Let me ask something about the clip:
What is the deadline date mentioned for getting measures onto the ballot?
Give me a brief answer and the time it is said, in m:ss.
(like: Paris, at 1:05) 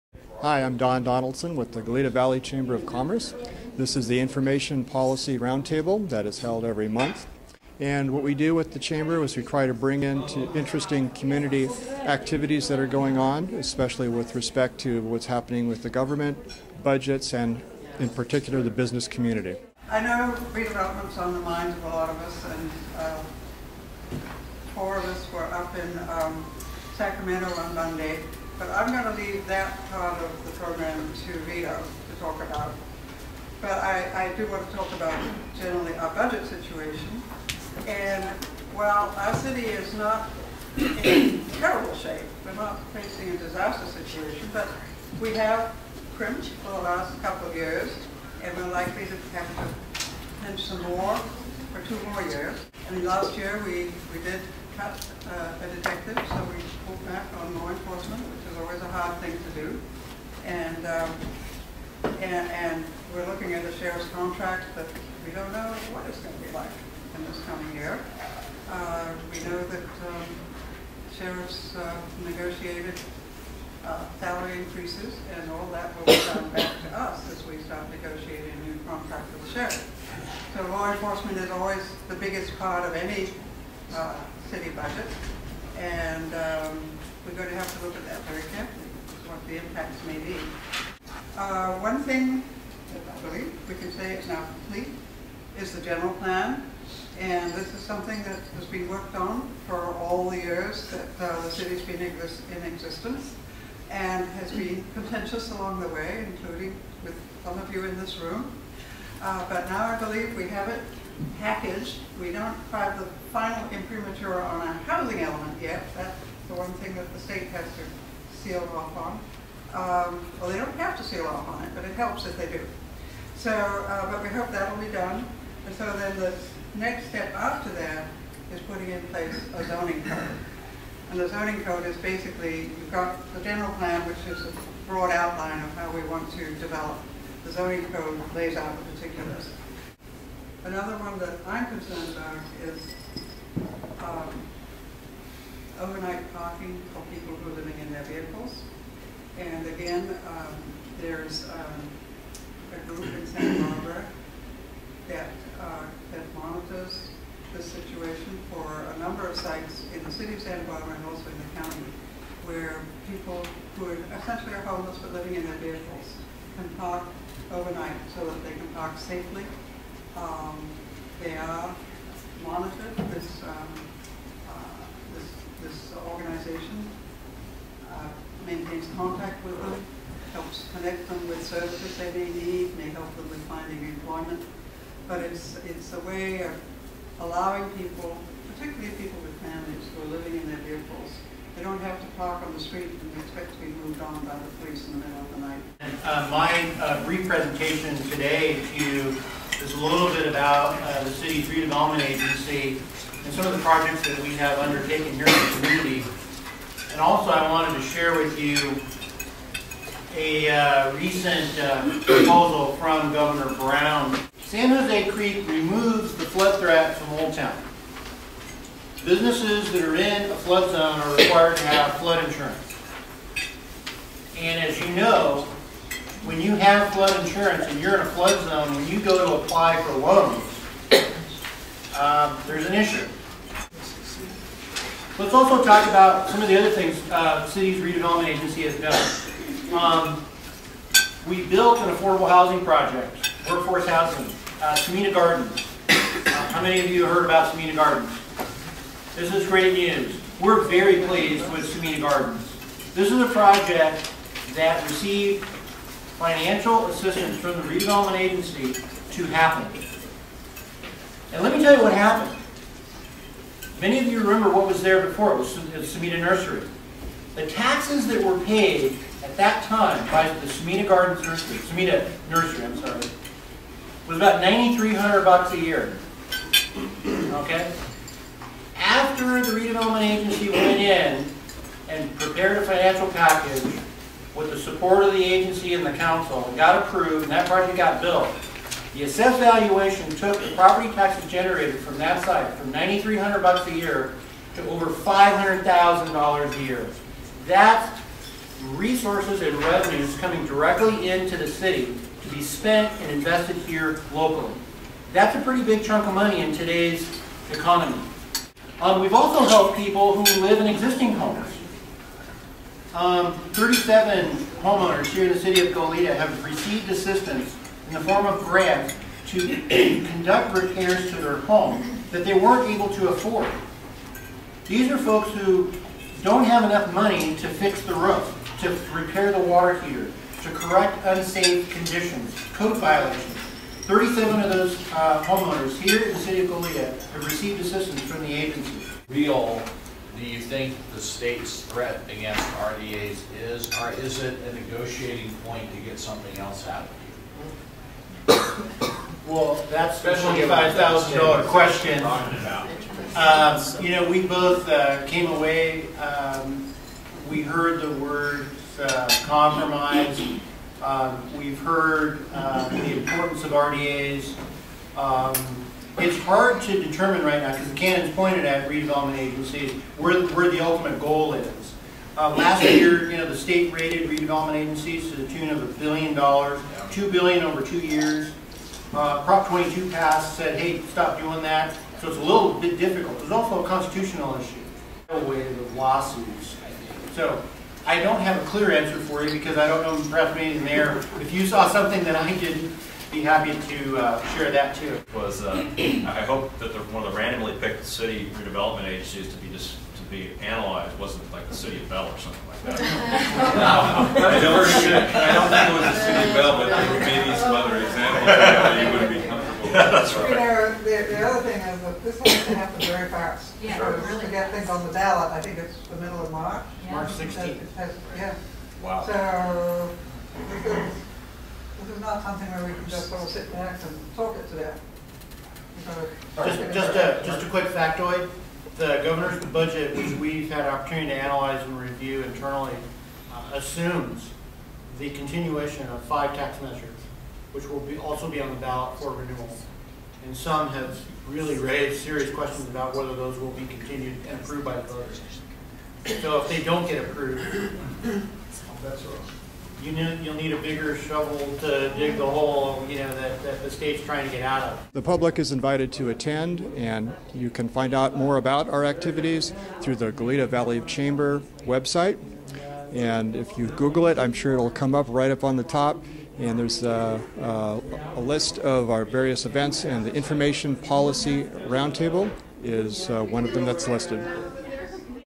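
March 16, at 6:56.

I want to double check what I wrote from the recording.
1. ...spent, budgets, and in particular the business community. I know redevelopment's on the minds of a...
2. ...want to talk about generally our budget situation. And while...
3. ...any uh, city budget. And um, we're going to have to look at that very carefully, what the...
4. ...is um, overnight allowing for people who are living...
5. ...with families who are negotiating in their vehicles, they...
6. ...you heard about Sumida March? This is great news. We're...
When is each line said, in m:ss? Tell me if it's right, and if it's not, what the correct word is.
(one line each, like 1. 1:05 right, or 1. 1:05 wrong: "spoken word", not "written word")
1. 0:15 wrong: "government", not "spent"
2. 0:34 right
3. 1:22 right
4. 2:22 wrong: "parking", not "allowing"
5. 3:09 wrong: "living", not "negotiating"
6. 4:06 wrong: "Gardens", not "March".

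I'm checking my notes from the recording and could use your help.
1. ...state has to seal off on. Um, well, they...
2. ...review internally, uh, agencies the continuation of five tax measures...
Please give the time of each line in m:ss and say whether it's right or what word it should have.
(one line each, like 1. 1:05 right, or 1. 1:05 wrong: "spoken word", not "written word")
1. 1:57 right
2. 7:11 wrong: "assumes", not "agencies".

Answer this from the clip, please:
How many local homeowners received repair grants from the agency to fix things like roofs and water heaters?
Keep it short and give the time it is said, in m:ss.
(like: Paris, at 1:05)
37, at 5:13.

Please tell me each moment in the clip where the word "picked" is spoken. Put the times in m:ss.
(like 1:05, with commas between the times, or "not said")
6:37.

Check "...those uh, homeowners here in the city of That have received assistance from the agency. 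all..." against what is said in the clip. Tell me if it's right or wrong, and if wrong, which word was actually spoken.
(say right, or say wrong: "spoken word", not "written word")
wrong: "Goleta", not "That".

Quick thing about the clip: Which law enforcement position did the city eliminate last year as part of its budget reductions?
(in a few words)
A detective.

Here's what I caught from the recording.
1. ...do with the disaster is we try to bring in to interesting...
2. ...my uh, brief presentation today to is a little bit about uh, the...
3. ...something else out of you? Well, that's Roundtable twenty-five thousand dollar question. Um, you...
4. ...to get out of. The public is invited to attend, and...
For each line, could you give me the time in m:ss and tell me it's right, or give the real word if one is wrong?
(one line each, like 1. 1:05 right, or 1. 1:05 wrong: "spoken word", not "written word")
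1. 0:08 wrong: "chamber", not "disaster"
2. 3:16 right
3. 5:45 wrong: "Especially", not "Roundtable"
4. 7:34 right.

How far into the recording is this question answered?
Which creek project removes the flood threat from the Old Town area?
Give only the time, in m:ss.
3:34.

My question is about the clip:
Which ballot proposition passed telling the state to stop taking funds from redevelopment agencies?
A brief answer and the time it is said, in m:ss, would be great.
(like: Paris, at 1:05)
Prop 22, at 6:19.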